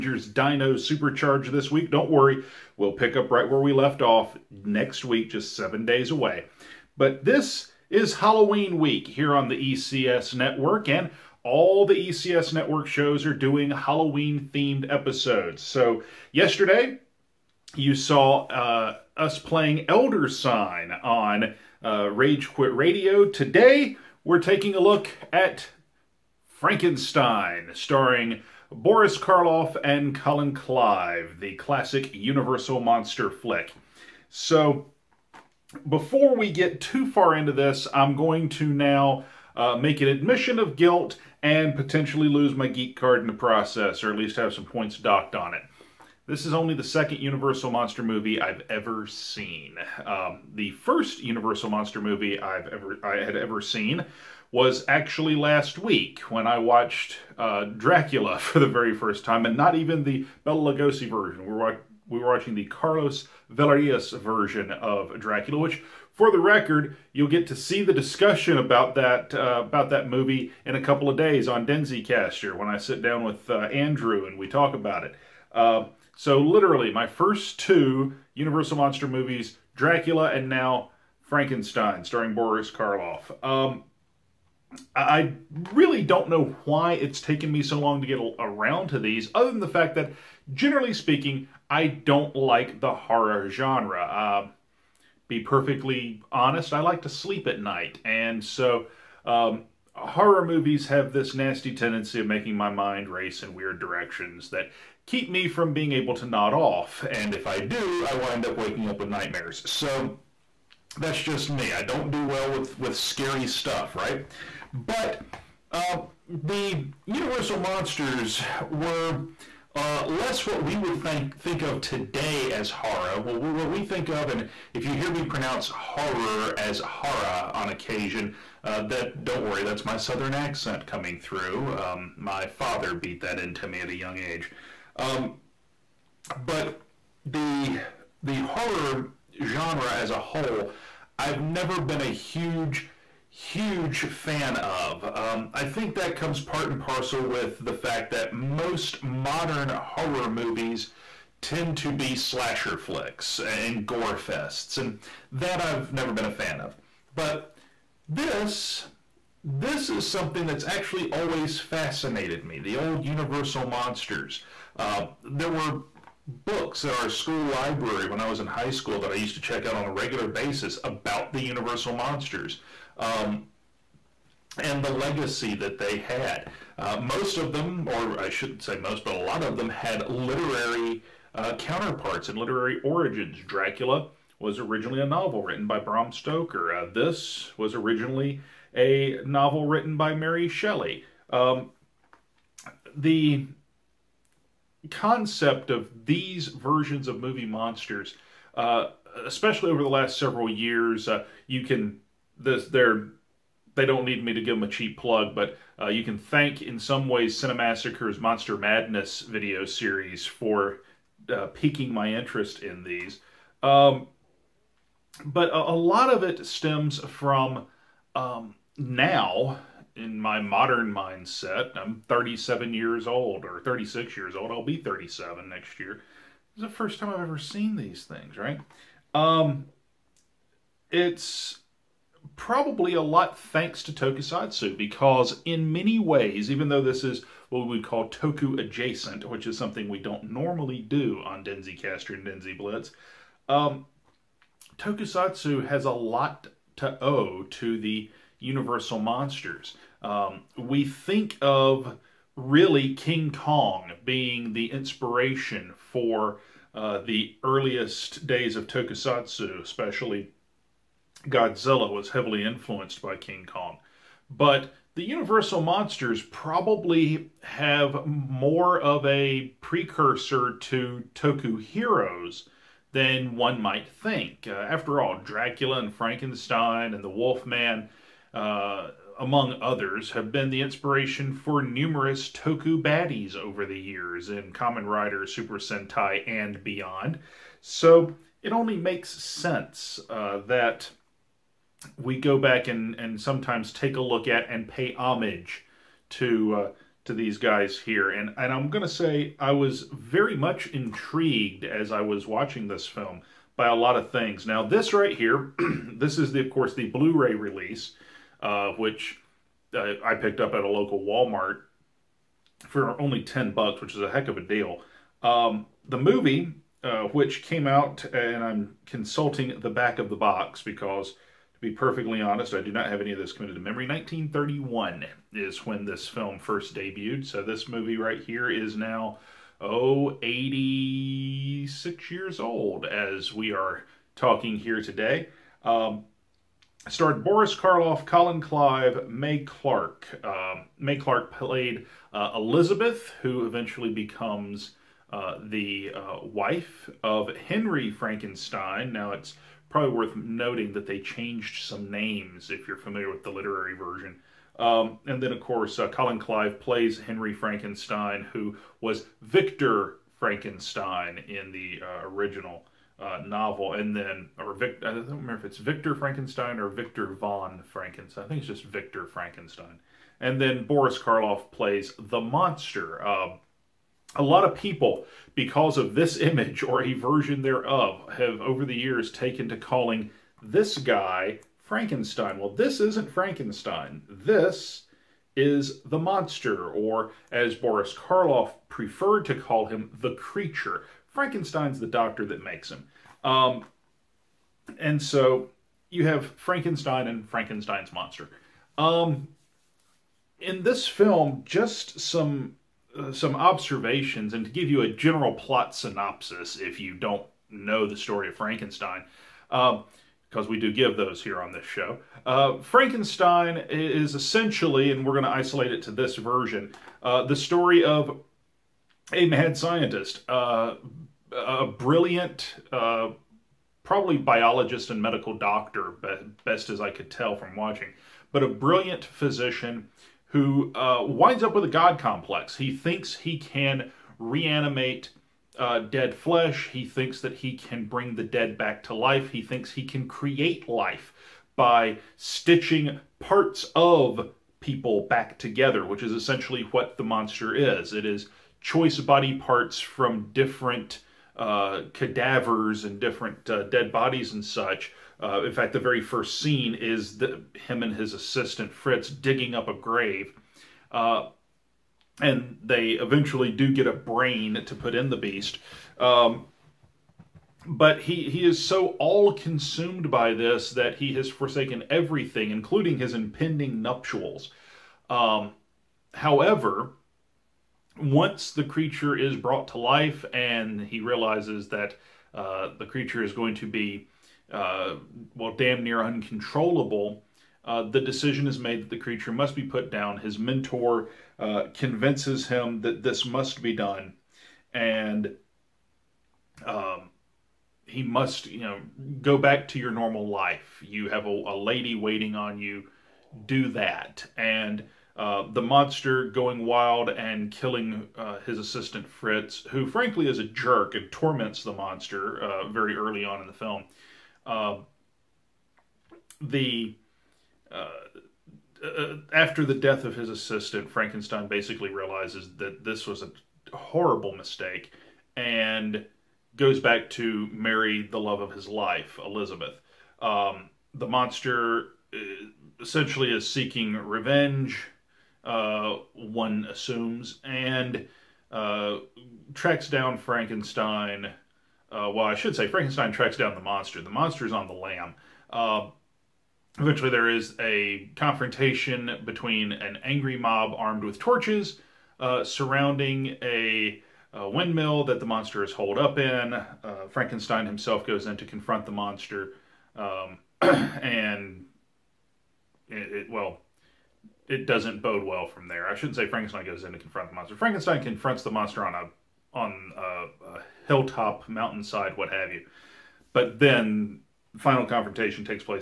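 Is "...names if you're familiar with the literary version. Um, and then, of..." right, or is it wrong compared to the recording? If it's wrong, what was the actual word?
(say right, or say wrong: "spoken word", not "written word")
right.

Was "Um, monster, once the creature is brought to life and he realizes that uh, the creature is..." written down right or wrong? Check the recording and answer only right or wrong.
wrong.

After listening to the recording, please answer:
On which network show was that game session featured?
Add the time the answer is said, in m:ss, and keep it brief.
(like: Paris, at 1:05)
Rage Quit Radio, at 0:22.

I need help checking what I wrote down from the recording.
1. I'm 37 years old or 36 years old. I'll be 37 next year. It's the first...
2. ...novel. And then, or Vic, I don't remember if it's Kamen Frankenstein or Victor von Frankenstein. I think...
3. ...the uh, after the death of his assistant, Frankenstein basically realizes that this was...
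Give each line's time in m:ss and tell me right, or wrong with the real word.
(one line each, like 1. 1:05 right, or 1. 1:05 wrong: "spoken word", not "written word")
1. 3:41 right
2. 6:03 wrong: "Victor", not "Kamen"
3. 8:36 right.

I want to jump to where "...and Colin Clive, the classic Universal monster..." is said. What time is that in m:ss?
0:29.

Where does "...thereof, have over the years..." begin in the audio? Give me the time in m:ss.
6:17.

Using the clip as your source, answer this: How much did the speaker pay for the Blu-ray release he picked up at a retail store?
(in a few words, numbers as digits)
10 dollars.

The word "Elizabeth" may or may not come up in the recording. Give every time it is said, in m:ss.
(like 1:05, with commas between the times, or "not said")
5:42, 8:49.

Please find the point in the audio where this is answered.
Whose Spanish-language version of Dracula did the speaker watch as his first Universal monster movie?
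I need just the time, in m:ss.
1:02.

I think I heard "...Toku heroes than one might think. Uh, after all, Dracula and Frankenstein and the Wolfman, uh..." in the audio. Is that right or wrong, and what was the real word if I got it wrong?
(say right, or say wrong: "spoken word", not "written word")
right.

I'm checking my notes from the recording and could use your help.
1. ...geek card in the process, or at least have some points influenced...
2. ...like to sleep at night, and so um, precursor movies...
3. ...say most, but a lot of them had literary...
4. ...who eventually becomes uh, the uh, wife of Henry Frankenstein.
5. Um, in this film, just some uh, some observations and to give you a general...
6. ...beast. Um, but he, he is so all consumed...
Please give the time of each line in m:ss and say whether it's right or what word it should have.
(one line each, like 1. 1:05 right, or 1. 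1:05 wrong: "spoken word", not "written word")
1. 0:42 wrong: "docked", not "influenced"
2. 1:36 wrong: "horror", not "precursor"
3. 2:58 right
4. 5:43 right
5. 6:38 right
6. 7:45 right.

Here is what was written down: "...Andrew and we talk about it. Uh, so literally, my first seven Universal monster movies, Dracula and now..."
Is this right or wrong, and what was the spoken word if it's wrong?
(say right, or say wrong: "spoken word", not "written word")
wrong: "two", not "seven".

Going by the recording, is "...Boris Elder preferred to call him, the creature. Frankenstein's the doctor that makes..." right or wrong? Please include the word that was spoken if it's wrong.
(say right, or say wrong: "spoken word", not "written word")
wrong: "Karloff", not "Elder".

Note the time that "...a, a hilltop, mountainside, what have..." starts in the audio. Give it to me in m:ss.
9:29.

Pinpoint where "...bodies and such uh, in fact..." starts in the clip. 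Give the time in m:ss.
7:33.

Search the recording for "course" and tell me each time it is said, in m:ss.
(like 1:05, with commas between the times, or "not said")
5:06, 5:55.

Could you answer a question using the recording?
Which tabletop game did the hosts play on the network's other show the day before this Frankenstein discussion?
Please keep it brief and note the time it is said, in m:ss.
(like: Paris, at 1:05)
Elder Sign, at 0:19.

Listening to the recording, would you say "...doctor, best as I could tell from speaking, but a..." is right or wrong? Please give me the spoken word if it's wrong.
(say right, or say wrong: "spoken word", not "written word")
wrong: "watching", not "speaking".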